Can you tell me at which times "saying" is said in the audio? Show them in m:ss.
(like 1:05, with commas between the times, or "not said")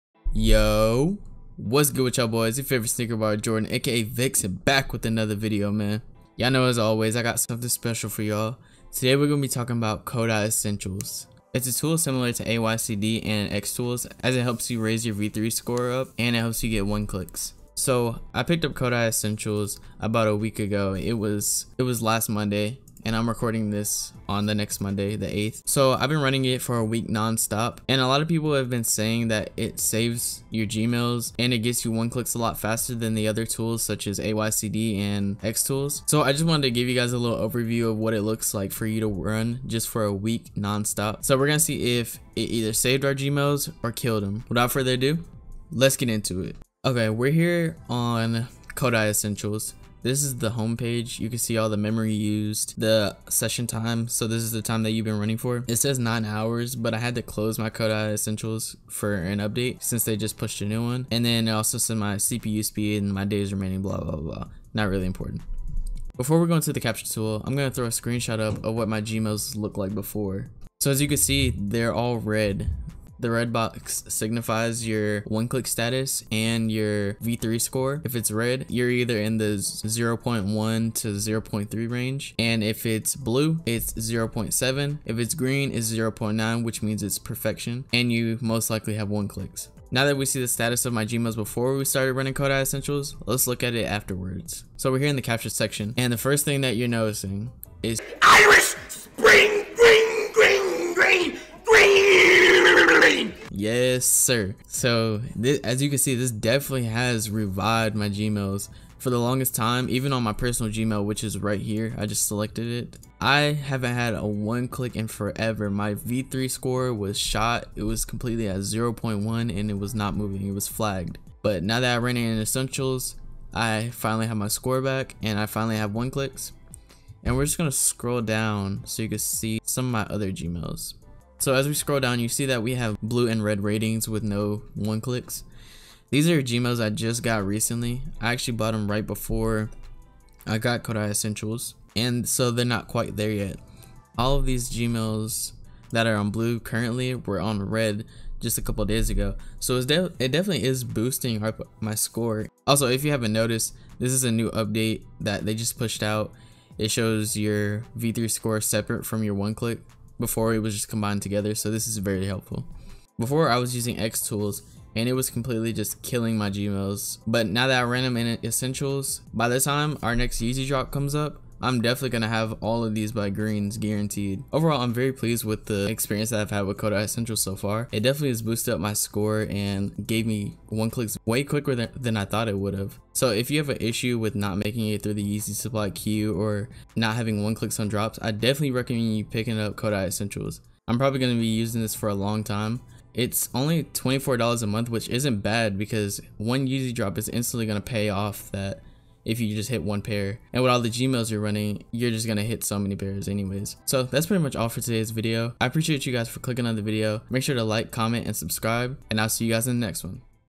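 0:28.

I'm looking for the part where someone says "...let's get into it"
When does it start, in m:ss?
0:45.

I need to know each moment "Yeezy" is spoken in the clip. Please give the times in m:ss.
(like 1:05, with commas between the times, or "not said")
2:50, 3:05, 3:16.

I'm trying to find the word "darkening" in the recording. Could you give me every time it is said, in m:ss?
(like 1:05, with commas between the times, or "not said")
not said.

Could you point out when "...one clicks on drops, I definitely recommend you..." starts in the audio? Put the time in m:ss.
3:07.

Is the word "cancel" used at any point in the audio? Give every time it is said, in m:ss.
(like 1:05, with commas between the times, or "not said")
not said.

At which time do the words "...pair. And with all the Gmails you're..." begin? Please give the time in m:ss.
3:20.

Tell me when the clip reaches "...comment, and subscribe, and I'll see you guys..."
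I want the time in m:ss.
3:27.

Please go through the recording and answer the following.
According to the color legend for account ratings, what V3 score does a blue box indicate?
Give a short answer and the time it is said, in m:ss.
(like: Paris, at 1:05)
0.7, at 1:23.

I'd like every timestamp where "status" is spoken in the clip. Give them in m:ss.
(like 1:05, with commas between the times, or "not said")
1:15, 1:30.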